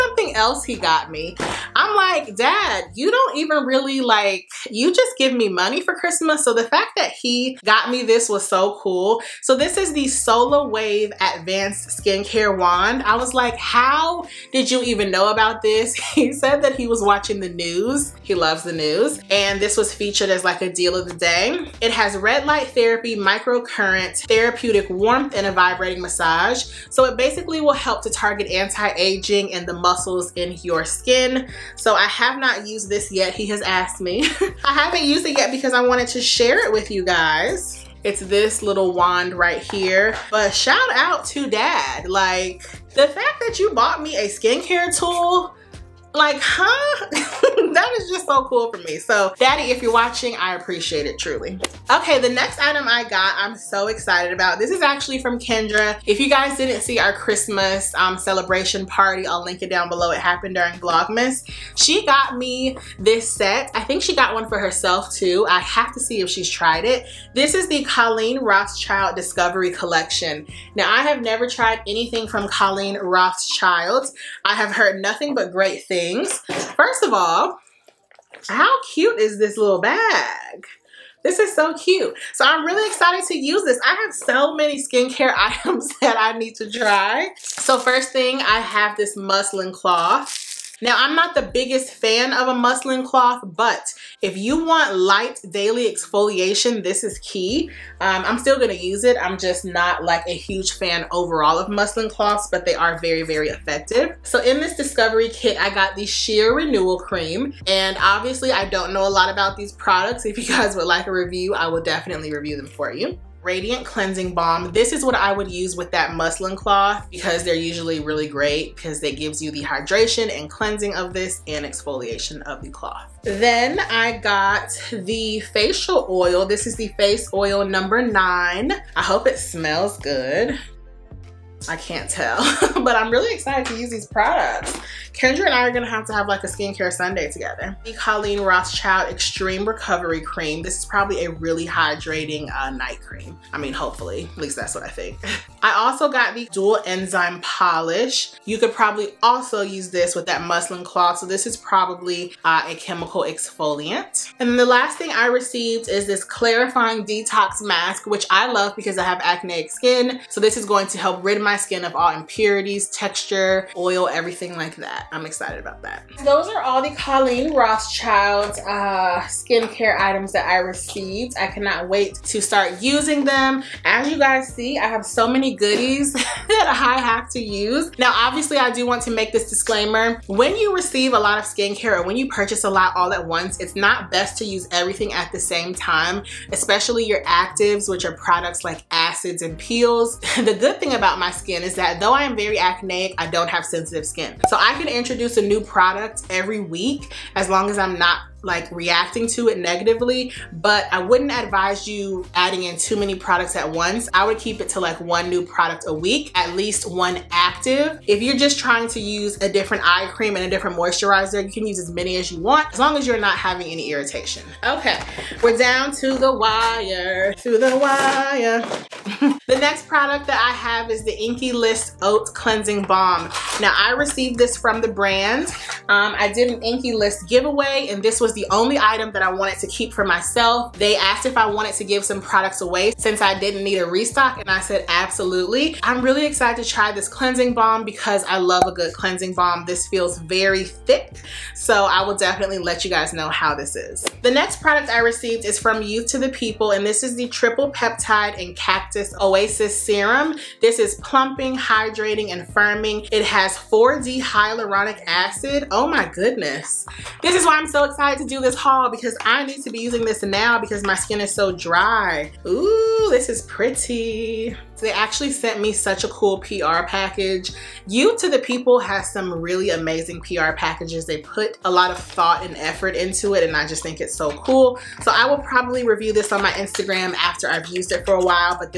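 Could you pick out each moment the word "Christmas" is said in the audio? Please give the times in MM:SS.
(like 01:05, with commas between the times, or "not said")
00:05, 00:57.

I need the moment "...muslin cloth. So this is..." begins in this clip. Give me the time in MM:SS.
02:30.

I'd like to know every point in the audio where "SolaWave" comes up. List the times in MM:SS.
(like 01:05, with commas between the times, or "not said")
00:10.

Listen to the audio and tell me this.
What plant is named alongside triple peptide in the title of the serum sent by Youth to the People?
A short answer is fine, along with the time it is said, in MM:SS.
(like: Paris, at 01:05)
Cactus, at 04:08.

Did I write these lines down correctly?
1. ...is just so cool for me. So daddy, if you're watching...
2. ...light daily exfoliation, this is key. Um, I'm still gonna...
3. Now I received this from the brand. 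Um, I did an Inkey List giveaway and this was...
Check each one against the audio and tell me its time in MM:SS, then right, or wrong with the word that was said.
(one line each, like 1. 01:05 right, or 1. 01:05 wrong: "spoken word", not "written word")
1. 00:47 right
2. 01:34 right
3. 03:43 right.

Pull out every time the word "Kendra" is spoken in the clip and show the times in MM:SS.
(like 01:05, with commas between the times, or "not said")
00:55, 02:15.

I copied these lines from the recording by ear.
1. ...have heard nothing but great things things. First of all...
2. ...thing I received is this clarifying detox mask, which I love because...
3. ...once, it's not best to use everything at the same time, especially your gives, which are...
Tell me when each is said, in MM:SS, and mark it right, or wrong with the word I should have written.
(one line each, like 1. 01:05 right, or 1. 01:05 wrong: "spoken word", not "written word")
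1. 01:14 right
2. 02:34 right
3. 03:03 wrong: "actives", not "gives".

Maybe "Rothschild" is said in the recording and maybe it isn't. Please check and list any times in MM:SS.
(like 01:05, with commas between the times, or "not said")
01:08, 01:12, 02:18, 02:47.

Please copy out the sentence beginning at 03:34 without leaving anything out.
Okay, we're down to the wire, to the wire.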